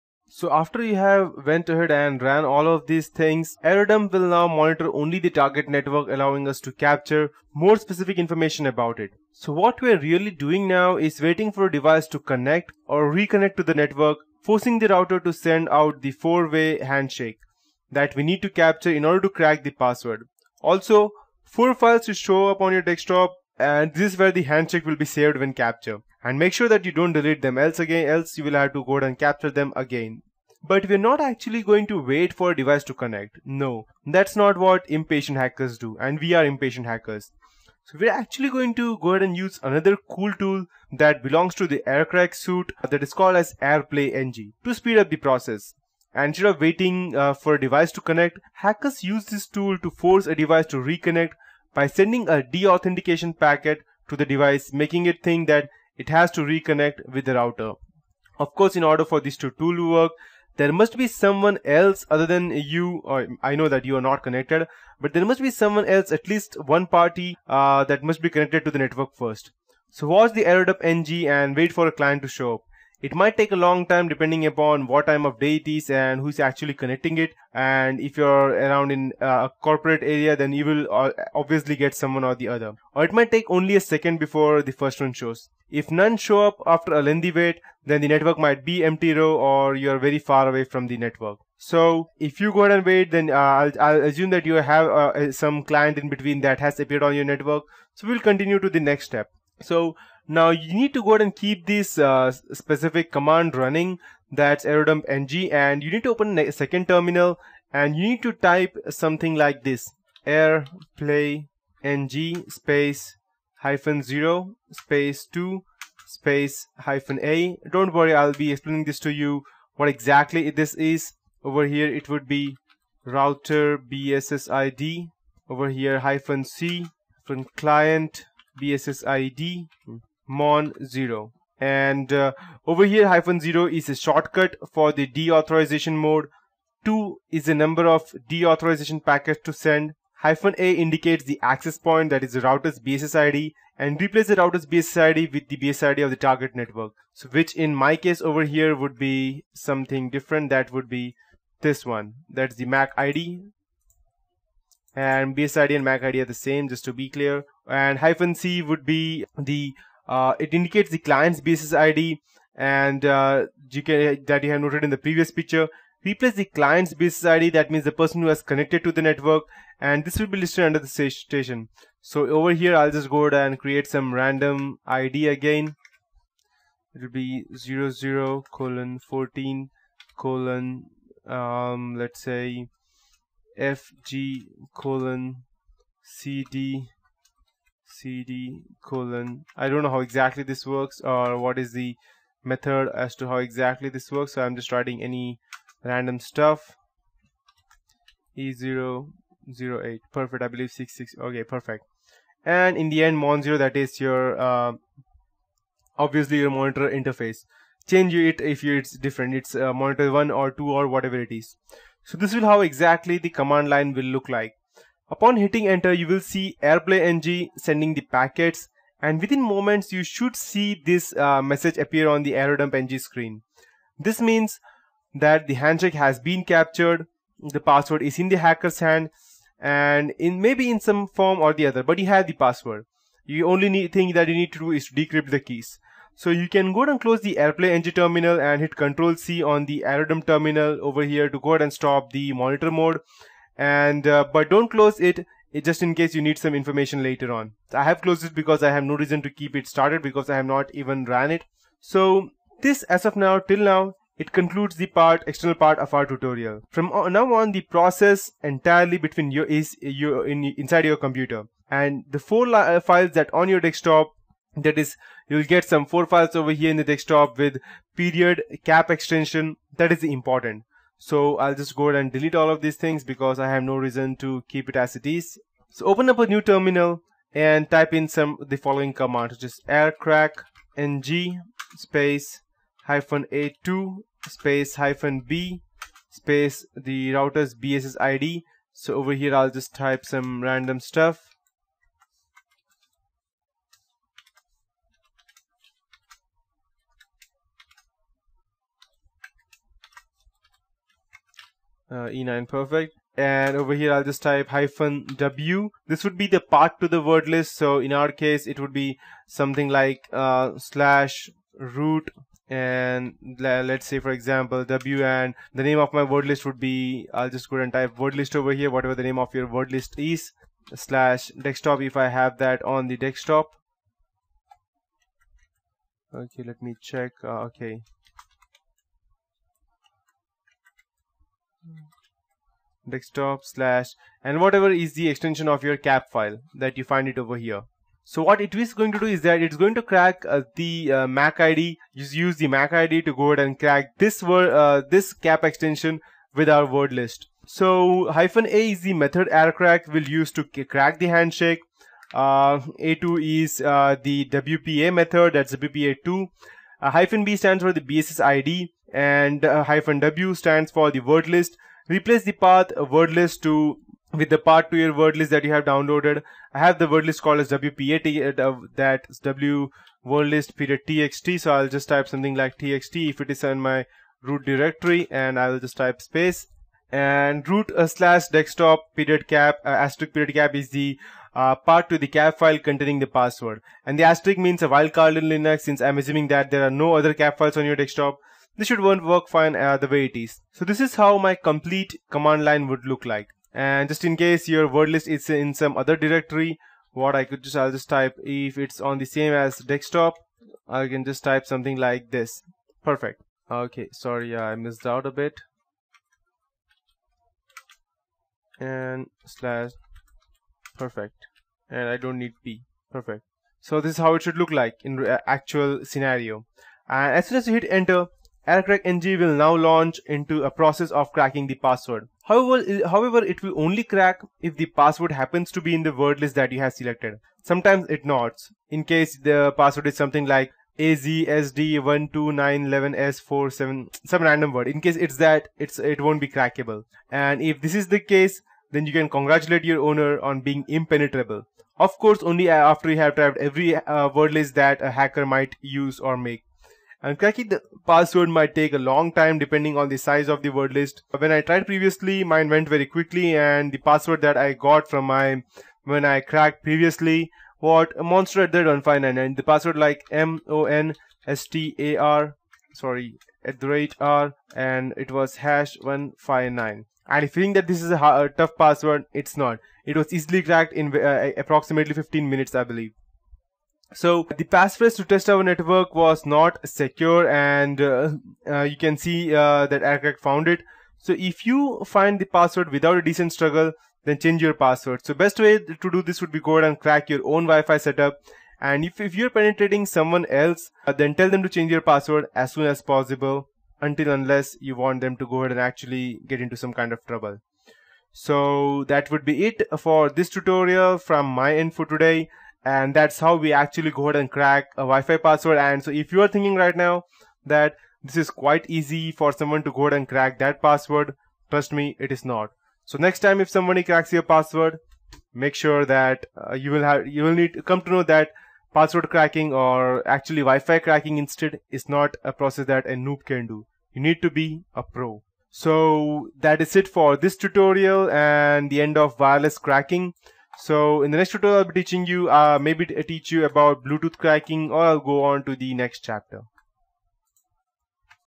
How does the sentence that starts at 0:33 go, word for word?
No, that's not what impatient hackers do and we are impatient hackers.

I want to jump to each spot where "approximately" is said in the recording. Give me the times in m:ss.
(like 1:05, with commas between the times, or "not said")
7:51.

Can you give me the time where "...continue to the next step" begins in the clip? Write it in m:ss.
1:38.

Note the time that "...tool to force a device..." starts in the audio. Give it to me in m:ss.
0:49.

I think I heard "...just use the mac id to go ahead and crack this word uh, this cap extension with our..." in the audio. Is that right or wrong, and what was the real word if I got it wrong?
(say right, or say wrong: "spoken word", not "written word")
right.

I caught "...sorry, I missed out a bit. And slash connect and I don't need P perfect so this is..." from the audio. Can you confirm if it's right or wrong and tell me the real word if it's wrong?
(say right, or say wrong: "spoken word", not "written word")
wrong: "perfect", not "connect".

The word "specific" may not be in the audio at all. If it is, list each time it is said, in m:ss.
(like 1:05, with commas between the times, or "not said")
0:07, 1:42.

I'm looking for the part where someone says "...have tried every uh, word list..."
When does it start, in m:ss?
7:22.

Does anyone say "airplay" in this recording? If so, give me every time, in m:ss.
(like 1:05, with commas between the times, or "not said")
0:43, 1:50, 3:36, 3:57.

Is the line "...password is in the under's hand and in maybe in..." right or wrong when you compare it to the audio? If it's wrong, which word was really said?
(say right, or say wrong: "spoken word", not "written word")
wrong: "hacker", not "under".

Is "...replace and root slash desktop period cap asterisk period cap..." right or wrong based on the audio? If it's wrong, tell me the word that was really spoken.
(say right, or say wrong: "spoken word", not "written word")
wrong: "space", not "replace".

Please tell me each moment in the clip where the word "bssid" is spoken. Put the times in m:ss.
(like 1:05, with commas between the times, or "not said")
2:03, 2:08.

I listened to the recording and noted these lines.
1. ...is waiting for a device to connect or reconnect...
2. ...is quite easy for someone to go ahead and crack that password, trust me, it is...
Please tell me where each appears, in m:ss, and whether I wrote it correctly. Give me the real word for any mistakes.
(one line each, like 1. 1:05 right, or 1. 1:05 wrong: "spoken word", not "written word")
1. 0:10 right
2. 8:28 right.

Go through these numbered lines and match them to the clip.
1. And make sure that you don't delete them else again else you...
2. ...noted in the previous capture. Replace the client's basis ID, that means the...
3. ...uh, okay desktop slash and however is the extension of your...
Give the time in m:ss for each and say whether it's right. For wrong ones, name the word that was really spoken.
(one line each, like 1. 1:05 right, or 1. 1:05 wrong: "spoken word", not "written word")
1. 0:26 right
2. 2:44 wrong: "picture", not "capture"
3. 5:27 wrong: "whatever", not "however".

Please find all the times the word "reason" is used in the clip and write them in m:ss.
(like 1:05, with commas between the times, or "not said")
4:08, 4:33.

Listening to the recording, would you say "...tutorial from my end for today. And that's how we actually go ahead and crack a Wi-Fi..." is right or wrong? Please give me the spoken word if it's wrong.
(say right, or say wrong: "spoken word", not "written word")
right.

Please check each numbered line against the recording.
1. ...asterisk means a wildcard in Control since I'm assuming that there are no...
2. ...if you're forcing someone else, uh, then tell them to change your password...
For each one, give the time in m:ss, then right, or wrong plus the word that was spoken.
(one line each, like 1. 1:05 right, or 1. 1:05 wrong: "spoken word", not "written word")
1. 6:24 wrong: "Linux", not "Control"
2. 8:09 wrong: "penetrating", not "forcing".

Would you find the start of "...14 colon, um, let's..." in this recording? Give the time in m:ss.
2:59.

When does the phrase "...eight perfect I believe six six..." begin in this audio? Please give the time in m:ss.
3:19.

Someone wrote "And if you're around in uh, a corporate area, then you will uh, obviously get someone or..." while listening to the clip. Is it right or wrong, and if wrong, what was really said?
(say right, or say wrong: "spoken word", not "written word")
right.